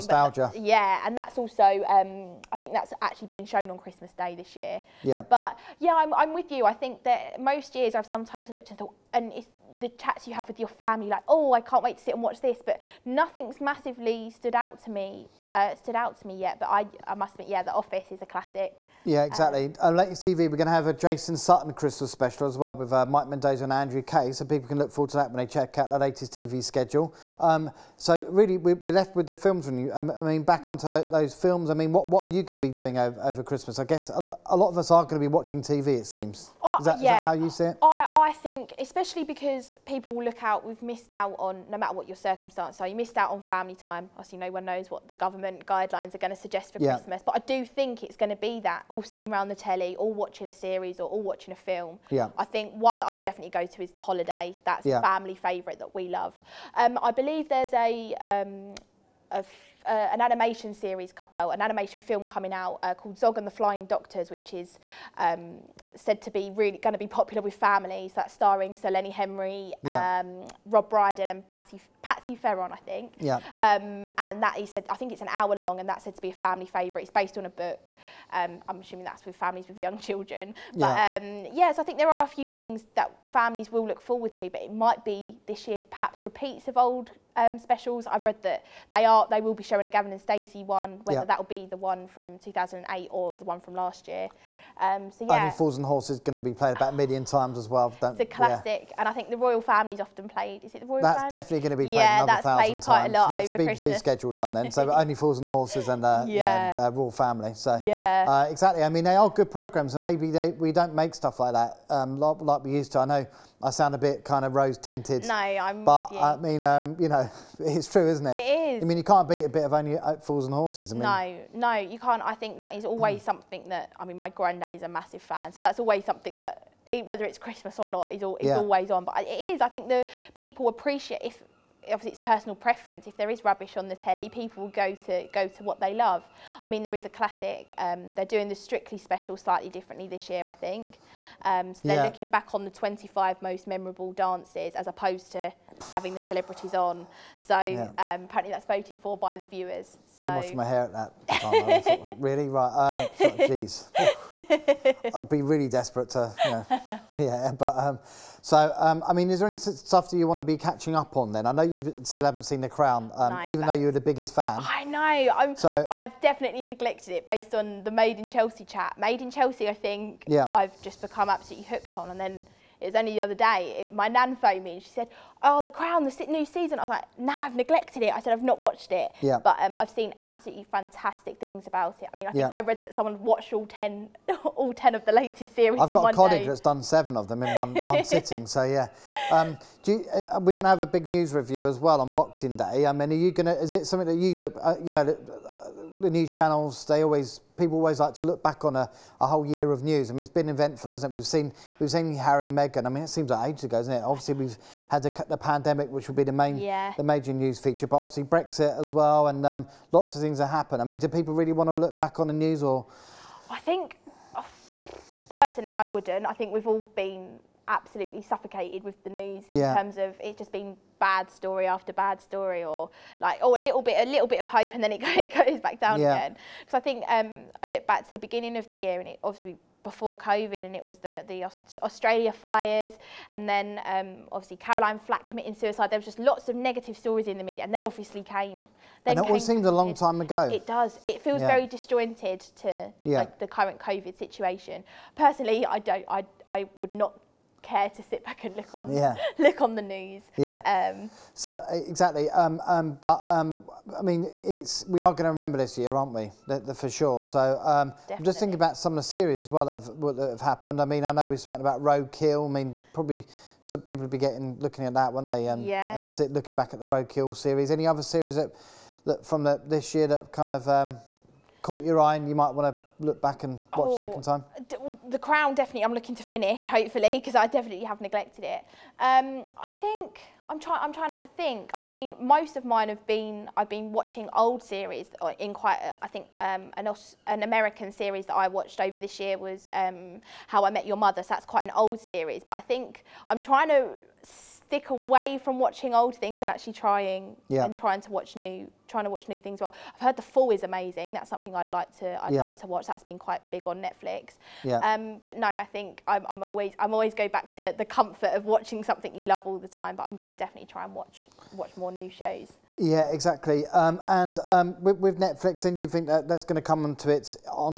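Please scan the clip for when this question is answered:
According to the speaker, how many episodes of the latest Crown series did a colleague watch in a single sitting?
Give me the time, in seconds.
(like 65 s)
186 s.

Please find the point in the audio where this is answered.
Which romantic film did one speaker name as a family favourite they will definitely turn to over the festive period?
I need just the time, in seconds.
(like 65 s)
53 s.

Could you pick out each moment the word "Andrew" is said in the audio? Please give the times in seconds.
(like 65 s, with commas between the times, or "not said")
23 s.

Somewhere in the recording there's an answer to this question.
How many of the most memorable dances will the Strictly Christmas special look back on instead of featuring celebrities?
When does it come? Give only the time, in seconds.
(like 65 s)
142 s.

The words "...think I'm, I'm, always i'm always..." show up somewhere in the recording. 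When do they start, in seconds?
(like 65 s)
305 s.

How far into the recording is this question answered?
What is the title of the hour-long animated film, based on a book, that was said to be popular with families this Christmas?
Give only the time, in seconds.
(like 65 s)
63 s.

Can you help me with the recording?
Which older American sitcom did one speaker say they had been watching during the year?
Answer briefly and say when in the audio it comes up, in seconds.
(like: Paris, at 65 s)
How I Met Your Mother, at 290 s.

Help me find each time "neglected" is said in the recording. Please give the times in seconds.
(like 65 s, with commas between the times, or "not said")
166 s, 177 s, 278 s.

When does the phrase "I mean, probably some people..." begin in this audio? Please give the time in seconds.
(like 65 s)
262 s.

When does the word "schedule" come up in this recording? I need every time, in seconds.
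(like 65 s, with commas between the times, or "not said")
26 s, 103 s.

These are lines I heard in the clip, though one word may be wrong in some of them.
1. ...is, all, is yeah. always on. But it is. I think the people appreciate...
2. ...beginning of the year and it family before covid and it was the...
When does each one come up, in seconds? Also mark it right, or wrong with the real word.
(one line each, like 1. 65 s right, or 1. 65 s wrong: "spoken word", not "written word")
1. 128 s right
2. 228 s wrong: "obviously", not "family".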